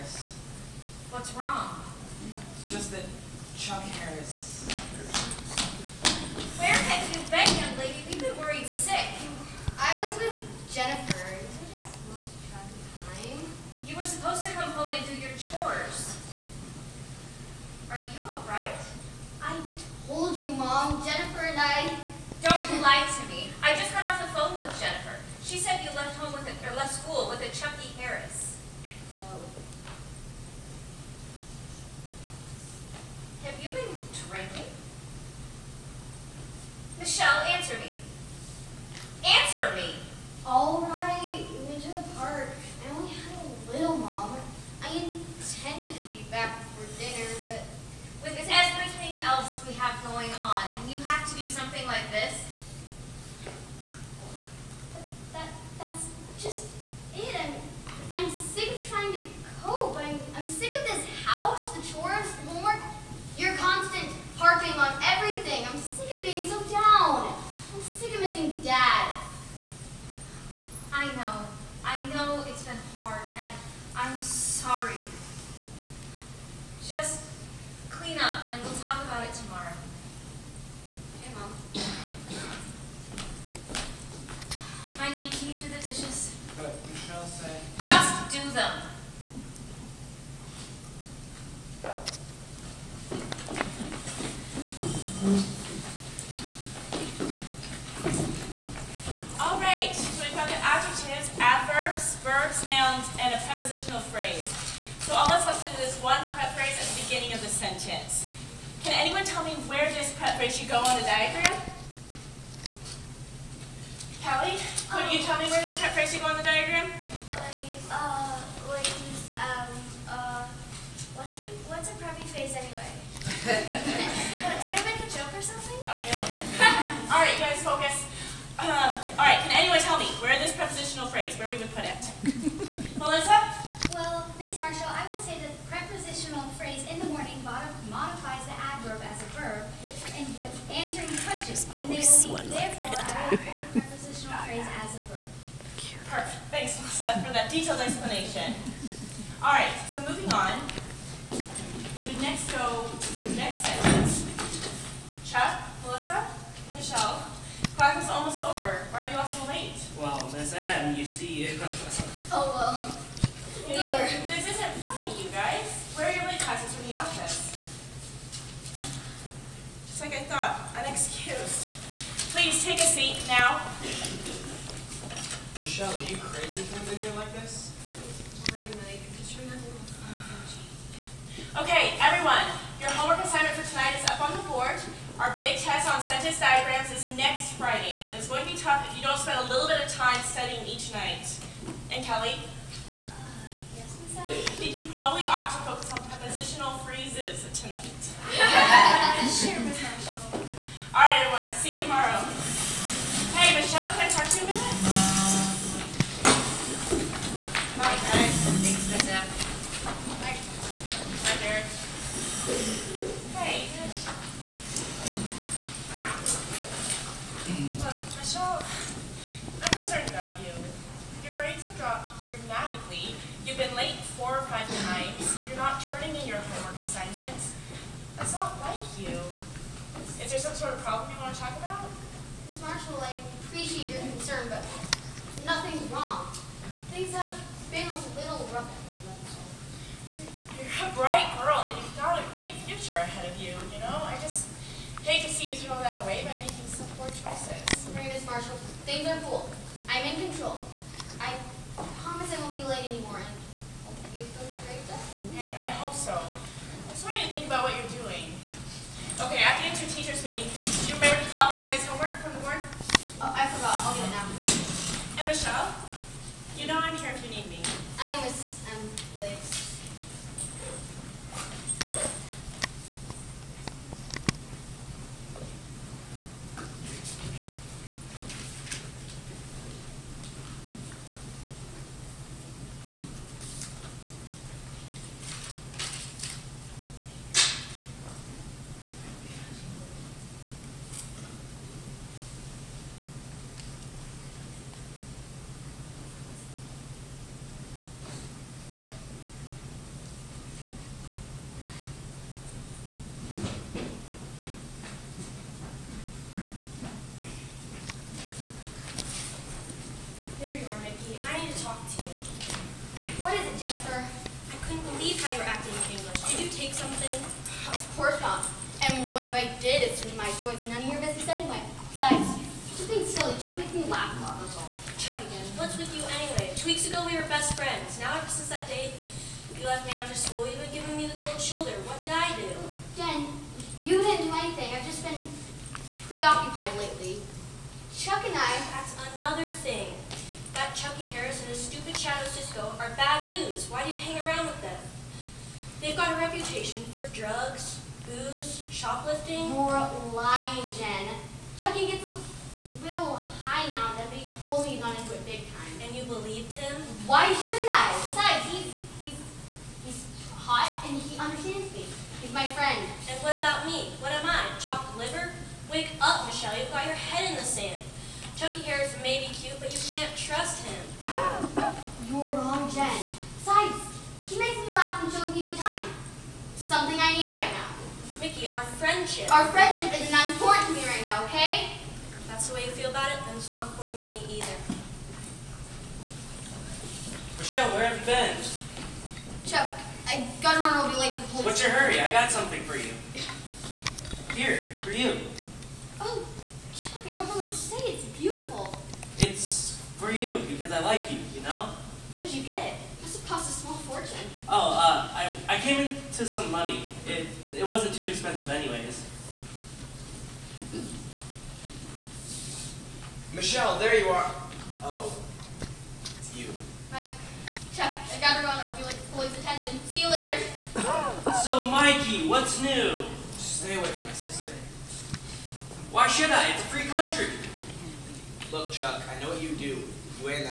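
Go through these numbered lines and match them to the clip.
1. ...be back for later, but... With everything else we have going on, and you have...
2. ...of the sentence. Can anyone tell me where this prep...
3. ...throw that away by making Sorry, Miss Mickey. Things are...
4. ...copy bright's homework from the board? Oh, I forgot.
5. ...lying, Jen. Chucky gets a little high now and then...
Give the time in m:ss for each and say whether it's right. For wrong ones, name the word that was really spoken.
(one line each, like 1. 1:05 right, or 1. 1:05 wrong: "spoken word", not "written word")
1. 0:46 wrong: "dinner", not "later"
2. 1:47 right
3. 4:05 wrong: "Marshall", not "Mickey"
4. 4:21 wrong: "tonight", not "bright"
5. 5:50 right.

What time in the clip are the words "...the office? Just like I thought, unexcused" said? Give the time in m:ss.
2:46.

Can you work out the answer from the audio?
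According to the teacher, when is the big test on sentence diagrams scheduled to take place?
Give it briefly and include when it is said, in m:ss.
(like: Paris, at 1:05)
Next Friday, at 3:07.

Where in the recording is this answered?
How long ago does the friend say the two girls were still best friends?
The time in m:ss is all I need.
5:26.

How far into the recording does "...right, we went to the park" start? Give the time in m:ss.
0:40.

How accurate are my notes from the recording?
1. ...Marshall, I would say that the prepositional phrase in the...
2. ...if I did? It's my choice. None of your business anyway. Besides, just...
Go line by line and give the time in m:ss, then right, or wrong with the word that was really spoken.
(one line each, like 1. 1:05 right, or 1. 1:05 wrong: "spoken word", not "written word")
1. 2:14 right
2. 5:19 right.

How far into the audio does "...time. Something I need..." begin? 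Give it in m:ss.
6:15.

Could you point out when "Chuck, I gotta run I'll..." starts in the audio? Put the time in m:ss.
6:29.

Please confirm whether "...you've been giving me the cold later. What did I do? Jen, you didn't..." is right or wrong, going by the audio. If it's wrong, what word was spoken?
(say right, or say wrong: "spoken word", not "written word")
wrong: "shoulder", not "later".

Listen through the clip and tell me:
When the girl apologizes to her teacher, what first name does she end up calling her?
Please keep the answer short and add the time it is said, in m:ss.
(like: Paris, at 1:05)
Liz, at 4:29.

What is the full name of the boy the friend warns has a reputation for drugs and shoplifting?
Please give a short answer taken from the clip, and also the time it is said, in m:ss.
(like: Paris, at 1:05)
Chuck Harris, at 0:03.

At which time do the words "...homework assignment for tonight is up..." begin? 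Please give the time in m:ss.
3:02.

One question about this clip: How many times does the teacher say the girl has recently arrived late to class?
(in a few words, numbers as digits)
4 or 5.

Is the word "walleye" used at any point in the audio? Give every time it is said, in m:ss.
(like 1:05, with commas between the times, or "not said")
not said.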